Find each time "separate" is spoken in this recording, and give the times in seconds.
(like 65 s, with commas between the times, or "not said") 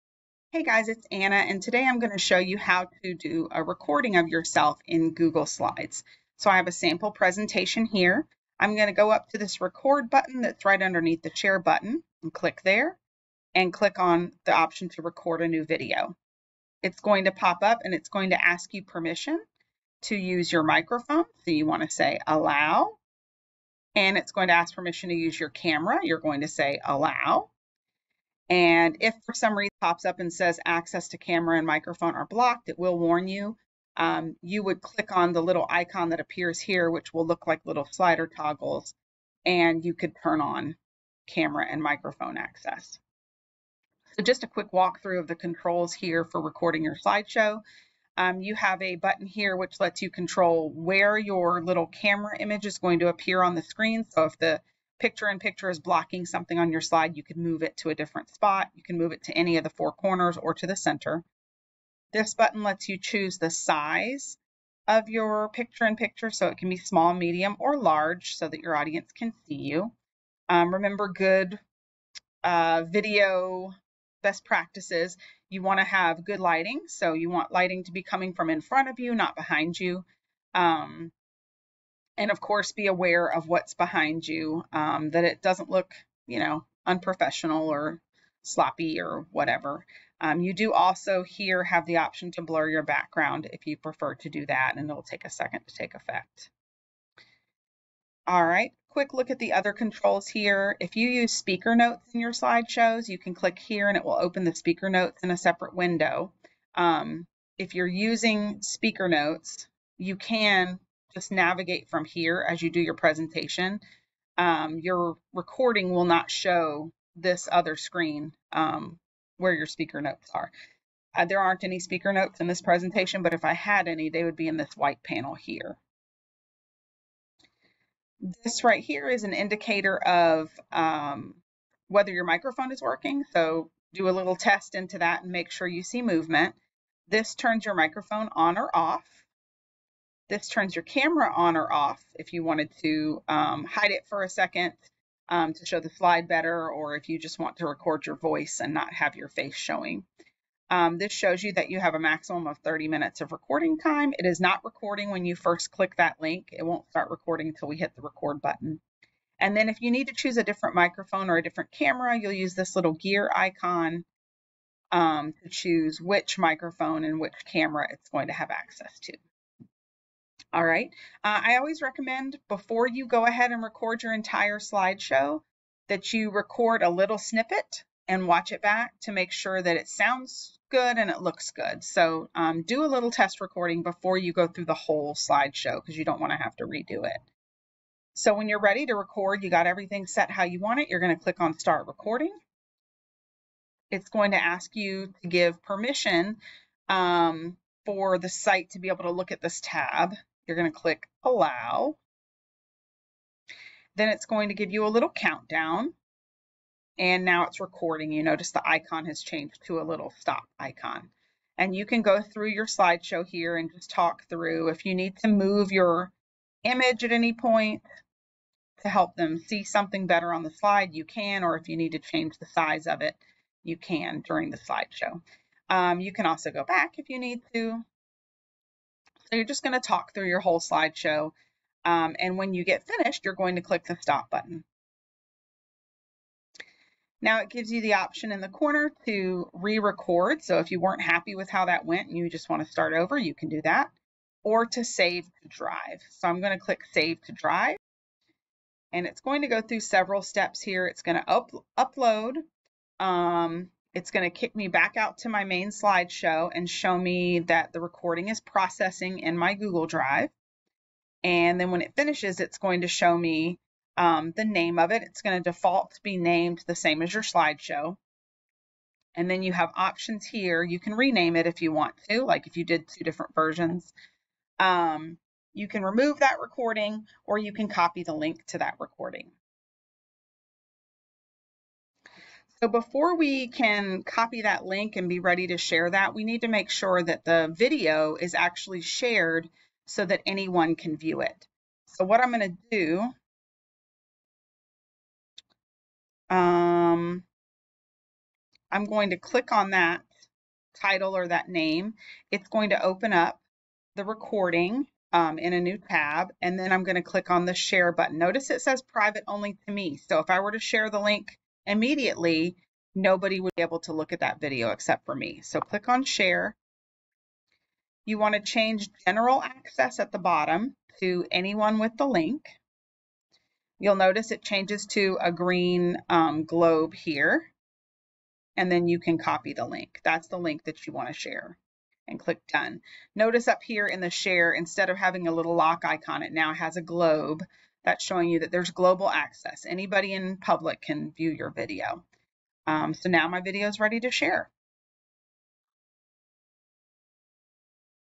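105 s.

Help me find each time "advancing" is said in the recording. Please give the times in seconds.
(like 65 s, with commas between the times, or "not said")
not said.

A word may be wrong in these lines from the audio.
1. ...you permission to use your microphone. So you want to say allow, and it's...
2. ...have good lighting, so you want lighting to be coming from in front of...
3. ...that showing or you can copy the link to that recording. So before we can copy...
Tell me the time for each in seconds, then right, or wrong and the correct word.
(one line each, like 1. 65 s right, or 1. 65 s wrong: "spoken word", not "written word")
1. 18 s right
2. 75 s right
3. 276 s wrong: "recording", not "showing".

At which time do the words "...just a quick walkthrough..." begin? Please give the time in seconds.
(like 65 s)
44 s.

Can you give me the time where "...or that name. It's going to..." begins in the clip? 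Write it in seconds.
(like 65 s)
301 s.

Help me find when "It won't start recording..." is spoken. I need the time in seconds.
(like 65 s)
156 s.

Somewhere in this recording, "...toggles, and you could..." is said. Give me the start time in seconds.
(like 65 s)
38 s.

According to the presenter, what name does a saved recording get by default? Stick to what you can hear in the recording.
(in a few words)
same as your slideshow.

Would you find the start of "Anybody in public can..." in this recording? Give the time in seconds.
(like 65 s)
339 s.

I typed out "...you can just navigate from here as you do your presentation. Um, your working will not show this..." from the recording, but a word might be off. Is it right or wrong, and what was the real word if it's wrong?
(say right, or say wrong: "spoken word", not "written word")
wrong: "recording", not "working".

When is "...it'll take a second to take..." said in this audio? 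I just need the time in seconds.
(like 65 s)
94 s.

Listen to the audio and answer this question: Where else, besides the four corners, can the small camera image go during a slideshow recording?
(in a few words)
the center.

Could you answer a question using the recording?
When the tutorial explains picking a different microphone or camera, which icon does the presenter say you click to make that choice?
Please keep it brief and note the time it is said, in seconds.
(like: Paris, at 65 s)
gear icon, at 162 s.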